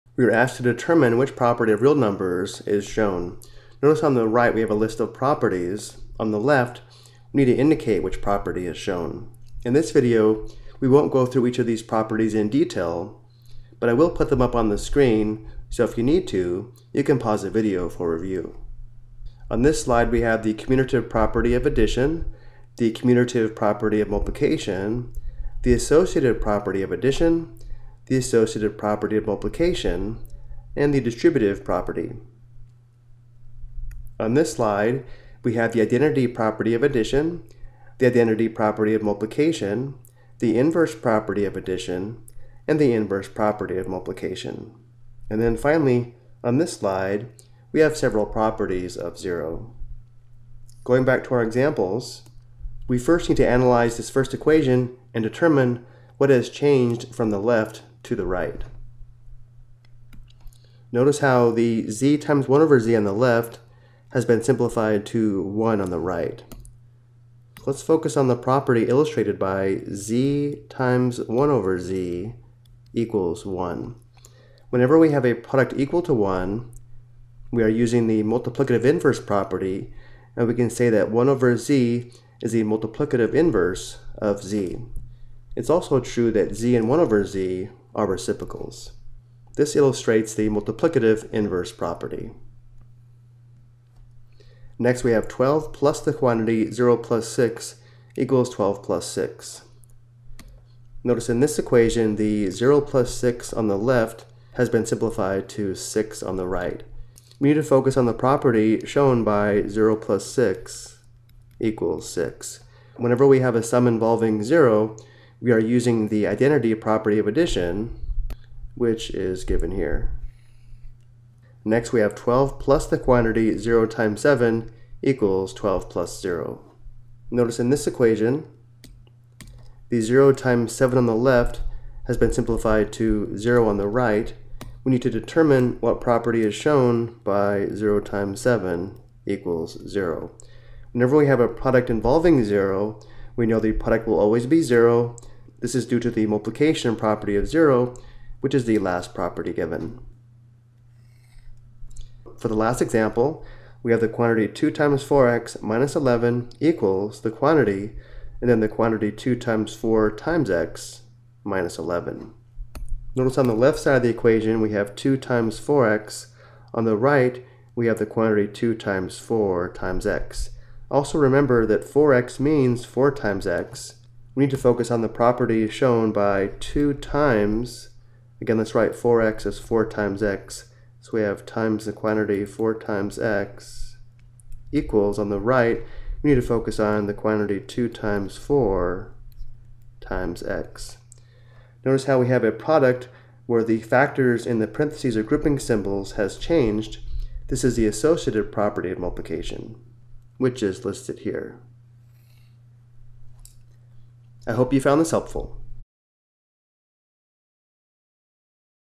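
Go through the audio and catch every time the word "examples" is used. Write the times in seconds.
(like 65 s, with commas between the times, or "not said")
51 s, 152 s.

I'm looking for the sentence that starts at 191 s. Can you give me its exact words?
Notice how we have a product where the factors in the parentheses or grouping symbols has changed.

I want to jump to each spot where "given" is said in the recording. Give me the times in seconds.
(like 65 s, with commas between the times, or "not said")
119 s, 149 s.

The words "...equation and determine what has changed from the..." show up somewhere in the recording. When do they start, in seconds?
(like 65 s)
54 s.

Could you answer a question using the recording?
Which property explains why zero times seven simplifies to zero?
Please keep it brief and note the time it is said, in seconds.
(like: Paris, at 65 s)
multiplication property of 0, at 146 s.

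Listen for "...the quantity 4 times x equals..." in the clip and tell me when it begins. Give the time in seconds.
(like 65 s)
181 s.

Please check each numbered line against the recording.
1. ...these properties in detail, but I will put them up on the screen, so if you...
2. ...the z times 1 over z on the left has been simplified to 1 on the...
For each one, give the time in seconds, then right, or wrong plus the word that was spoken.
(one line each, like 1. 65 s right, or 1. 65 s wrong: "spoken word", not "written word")
1. 11 s right
2. 61 s right.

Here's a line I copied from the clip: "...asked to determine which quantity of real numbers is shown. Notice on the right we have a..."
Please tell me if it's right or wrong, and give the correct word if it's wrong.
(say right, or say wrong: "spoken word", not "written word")
wrong: "property", not "quantity".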